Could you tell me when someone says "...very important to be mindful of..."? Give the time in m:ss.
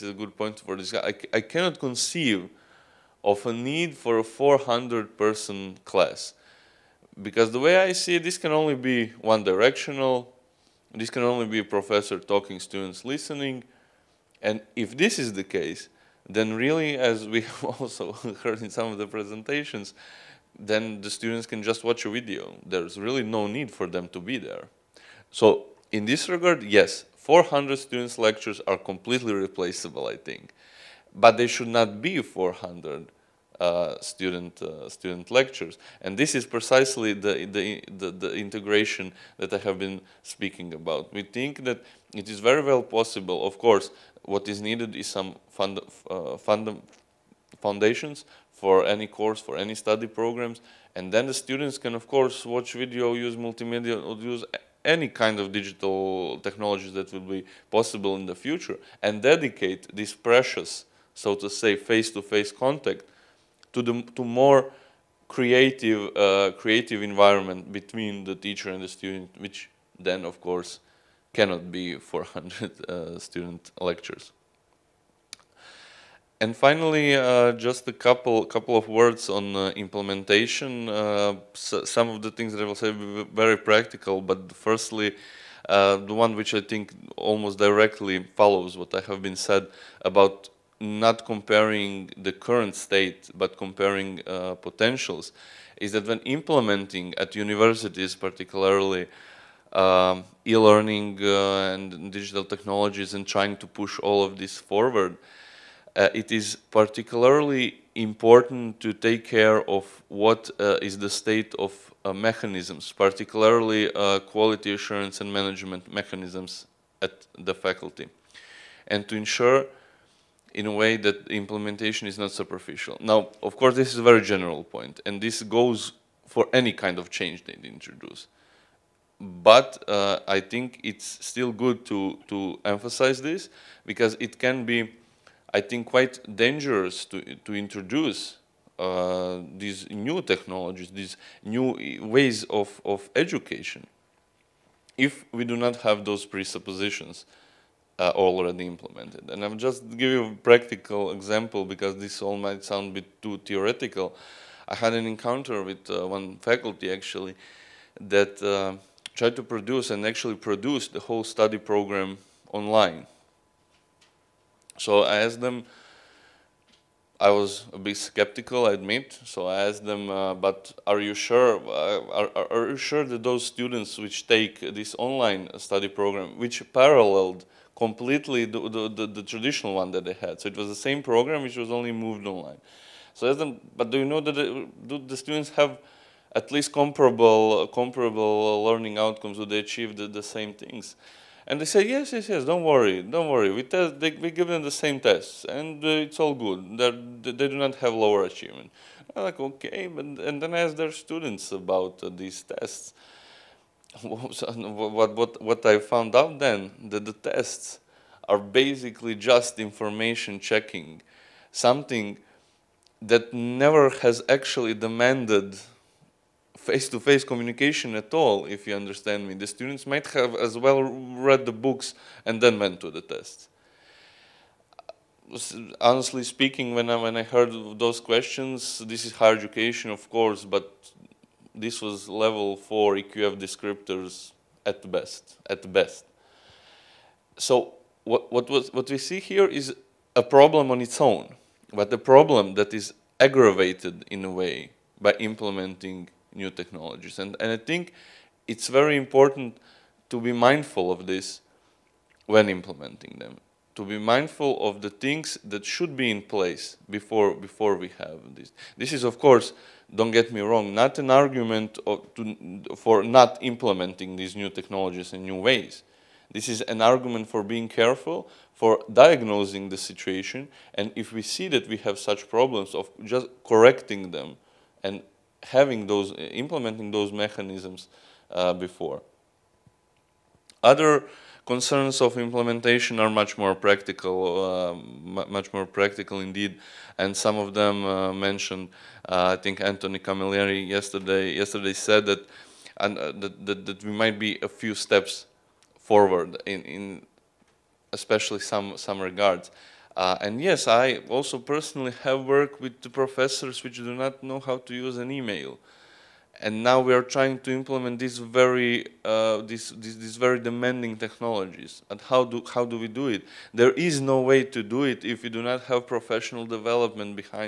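4:08.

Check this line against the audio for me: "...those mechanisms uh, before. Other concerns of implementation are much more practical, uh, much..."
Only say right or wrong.
right.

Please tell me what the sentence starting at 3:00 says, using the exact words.
So it was the same program, which was only moved online.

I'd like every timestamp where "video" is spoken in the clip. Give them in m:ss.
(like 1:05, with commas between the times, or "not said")
0:22, 0:52.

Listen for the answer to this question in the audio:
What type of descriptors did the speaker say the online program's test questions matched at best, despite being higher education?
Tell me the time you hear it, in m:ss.
3:52.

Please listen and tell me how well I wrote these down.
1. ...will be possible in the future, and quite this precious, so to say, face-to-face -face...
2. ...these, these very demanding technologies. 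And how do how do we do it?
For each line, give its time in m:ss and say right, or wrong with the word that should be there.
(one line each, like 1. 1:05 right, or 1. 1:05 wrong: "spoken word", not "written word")
1. 0:57 wrong: "dedicate", not "quite"
2. 5:09 right.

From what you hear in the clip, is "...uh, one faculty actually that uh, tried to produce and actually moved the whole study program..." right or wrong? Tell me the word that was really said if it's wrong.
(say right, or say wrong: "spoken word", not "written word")
wrong: "produced", not "moved".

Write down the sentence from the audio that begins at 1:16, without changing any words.
And finally, uh, just a couple couple of words on uh, implementation.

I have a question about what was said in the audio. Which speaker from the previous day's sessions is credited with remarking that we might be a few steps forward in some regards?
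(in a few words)
Anthony Camilleri.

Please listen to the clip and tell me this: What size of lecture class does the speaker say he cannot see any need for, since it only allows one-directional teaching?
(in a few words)
400 person class.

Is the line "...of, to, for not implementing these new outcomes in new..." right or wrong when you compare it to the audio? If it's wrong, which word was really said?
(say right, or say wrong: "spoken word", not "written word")
wrong: "technologies", not "outcomes".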